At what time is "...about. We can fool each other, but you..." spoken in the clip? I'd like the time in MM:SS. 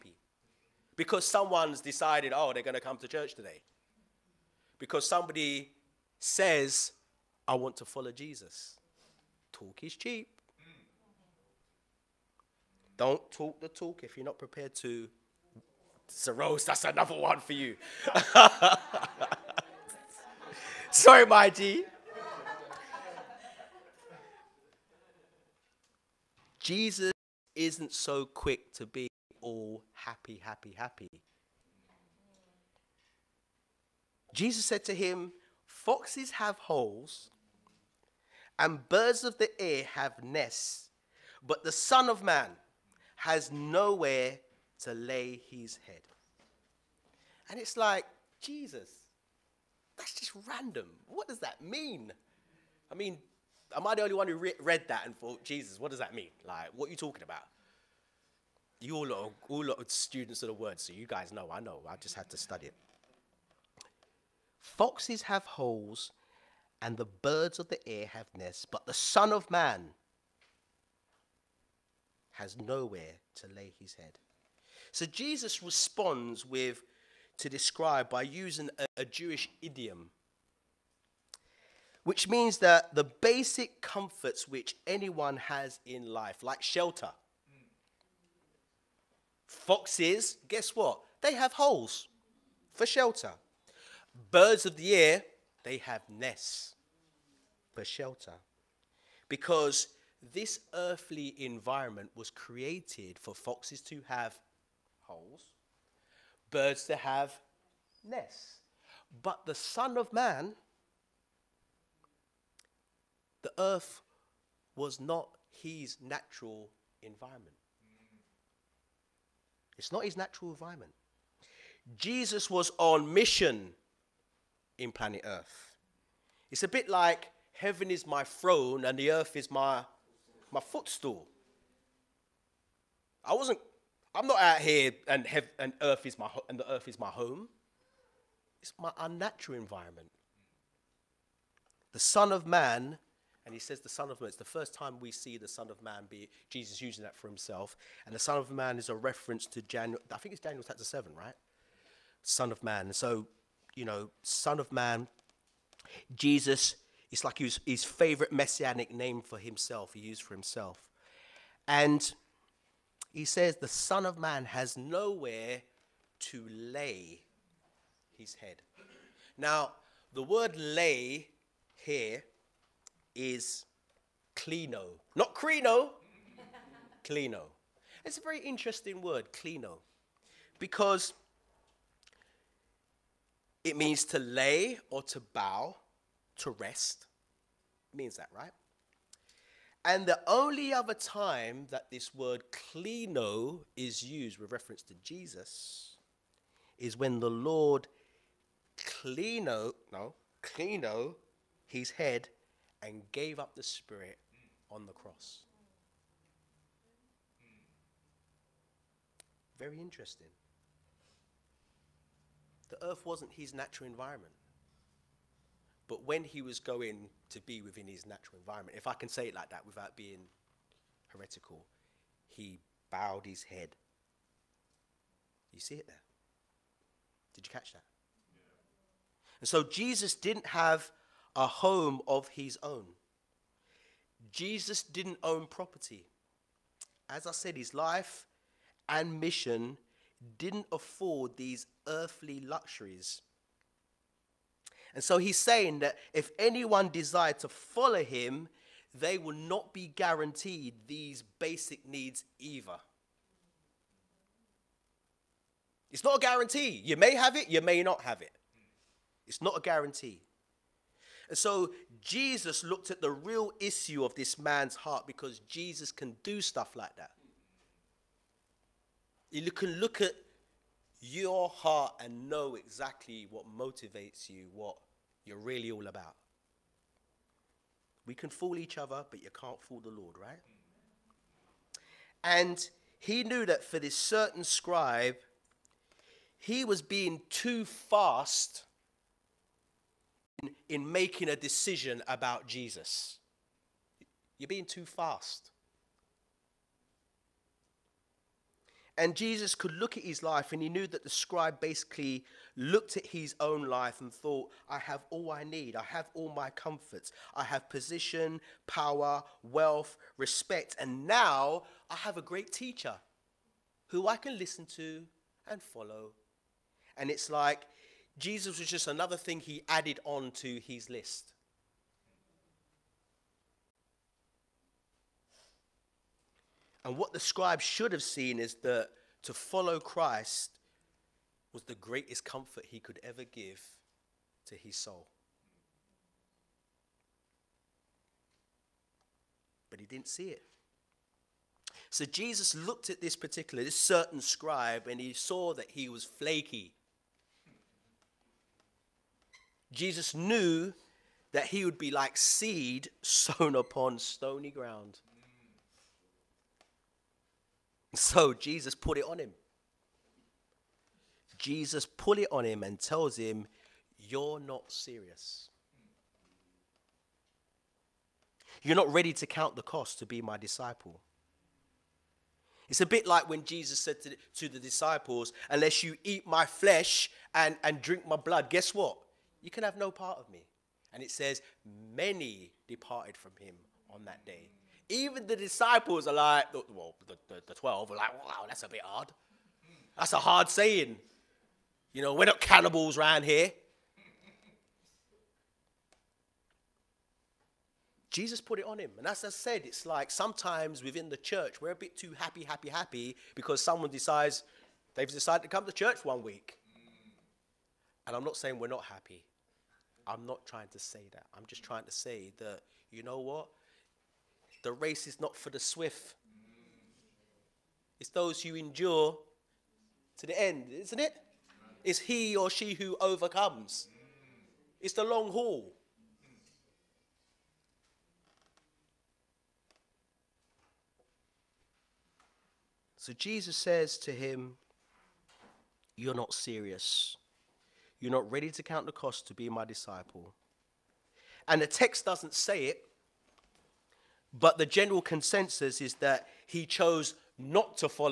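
04:35.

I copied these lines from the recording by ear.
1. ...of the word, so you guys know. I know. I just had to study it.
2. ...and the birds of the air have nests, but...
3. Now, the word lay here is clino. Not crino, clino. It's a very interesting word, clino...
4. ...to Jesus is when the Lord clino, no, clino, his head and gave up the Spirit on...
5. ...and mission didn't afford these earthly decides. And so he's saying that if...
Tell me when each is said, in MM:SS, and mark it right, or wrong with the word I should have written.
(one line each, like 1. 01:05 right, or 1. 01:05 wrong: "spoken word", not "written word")
1. 01:00 right
2. 01:06 right
3. 02:49 right
4. 03:14 right
5. 03:58 wrong: "luxuries", not "decides".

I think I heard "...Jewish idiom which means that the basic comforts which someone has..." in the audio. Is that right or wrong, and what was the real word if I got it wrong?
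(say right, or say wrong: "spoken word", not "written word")
wrong: "anyone", not "someone".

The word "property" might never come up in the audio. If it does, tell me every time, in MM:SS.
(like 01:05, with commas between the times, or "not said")
03:55.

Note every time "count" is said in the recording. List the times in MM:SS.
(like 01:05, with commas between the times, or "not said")
06:09, 07:18.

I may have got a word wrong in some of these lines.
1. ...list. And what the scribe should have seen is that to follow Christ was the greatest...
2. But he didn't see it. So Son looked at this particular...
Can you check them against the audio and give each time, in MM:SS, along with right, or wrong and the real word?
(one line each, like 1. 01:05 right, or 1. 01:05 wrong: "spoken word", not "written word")
1. 05:20 right
2. 05:39 wrong: "Jesus", not "Son".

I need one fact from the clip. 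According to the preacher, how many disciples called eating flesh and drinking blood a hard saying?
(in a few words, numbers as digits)
12.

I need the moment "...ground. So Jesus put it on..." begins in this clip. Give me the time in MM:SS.
05:54.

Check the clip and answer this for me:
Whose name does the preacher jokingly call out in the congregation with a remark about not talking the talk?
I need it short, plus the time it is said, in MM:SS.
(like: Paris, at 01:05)
Rose, at 00:16.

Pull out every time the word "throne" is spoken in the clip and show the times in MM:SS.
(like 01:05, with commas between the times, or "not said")
02:08.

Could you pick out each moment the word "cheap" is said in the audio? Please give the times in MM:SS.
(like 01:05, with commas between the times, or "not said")
00:09.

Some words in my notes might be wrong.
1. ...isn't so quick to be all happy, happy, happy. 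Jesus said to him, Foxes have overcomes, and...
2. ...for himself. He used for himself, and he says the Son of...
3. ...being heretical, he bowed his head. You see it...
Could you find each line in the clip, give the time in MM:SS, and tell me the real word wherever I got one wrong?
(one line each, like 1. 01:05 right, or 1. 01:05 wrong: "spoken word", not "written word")
1. 00:27 wrong: "holes", not "overcomes"
2. 02:39 right
3. 03:39 right.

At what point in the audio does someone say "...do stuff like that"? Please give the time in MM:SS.
04:26.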